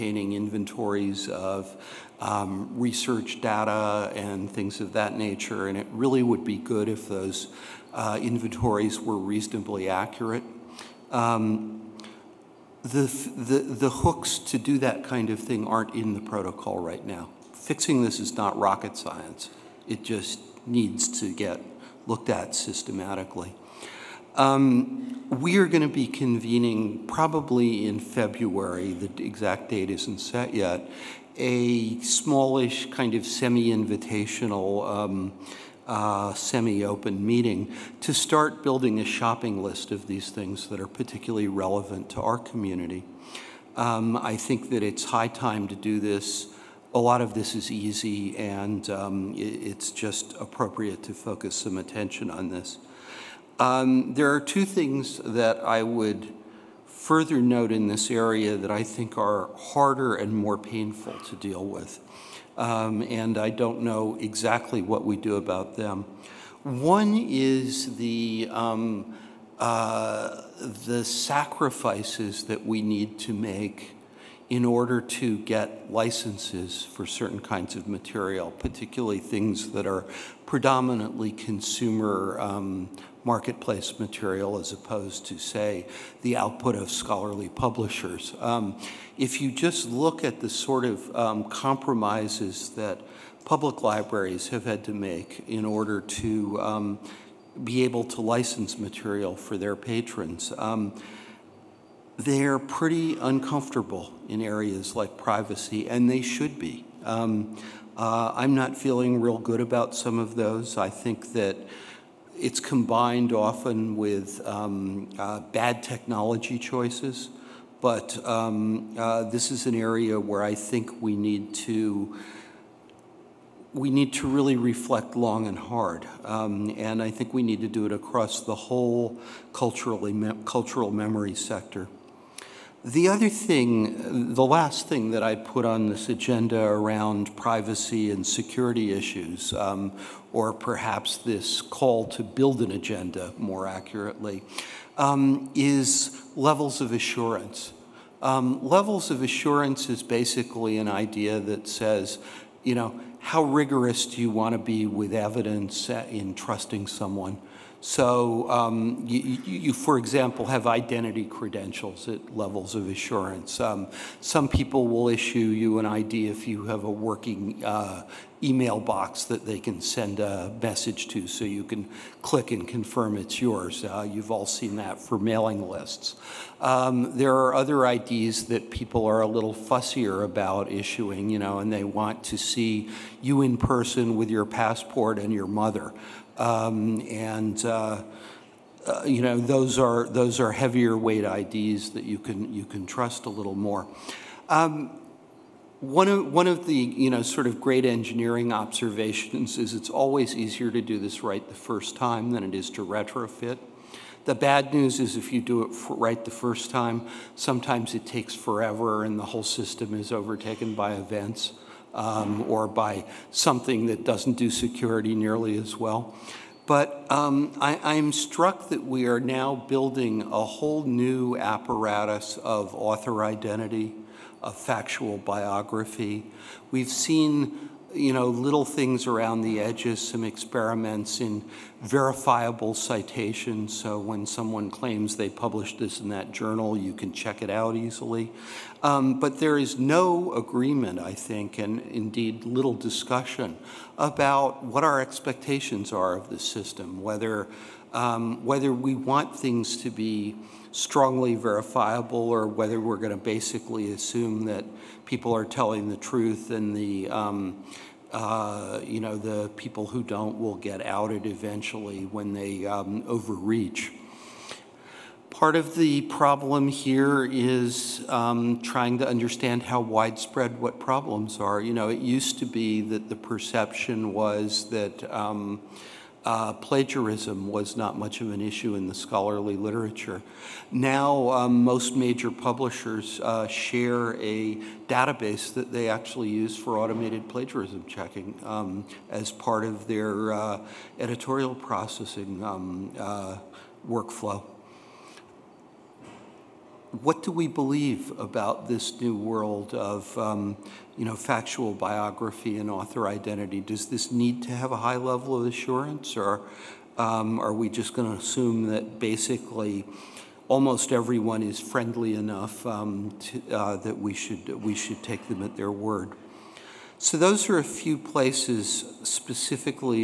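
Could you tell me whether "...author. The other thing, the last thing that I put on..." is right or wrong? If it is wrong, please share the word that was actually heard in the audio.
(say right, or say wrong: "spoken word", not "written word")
wrong: "sector", not "author".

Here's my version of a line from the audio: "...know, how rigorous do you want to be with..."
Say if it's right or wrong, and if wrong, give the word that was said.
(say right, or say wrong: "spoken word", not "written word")
right.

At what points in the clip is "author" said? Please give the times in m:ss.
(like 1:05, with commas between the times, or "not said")
3:42, 5:02.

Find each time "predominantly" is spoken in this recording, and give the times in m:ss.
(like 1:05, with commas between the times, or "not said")
1:20.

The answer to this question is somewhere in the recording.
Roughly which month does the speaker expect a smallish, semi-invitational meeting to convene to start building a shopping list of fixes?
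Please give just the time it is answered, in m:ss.
0:27.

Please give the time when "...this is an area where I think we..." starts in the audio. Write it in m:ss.
1:59.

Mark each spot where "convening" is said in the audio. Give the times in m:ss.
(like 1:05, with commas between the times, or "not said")
0:26.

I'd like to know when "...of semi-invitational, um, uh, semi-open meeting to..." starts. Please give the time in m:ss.
0:33.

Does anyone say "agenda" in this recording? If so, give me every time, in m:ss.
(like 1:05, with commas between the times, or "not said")
2:16, 2:22.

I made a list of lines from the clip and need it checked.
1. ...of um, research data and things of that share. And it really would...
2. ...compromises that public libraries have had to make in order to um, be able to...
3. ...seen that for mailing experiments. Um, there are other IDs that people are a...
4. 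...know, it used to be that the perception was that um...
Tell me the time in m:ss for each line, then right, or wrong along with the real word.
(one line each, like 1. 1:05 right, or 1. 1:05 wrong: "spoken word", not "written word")
1. 0:01 wrong: "nature", not "share"
2. 1:31 right
3. 2:54 wrong: "lists", not "experiments"
4. 4:31 right.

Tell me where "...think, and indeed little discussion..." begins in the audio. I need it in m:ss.
4:01.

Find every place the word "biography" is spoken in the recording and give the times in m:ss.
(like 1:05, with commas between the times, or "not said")
3:45, 5:01.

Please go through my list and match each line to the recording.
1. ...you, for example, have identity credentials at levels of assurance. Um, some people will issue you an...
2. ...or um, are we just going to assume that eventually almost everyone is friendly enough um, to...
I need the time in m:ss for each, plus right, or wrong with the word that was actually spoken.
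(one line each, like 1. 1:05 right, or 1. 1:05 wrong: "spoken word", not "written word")
1. 2:39 right
2. 5:06 wrong: "basically", not "eventually".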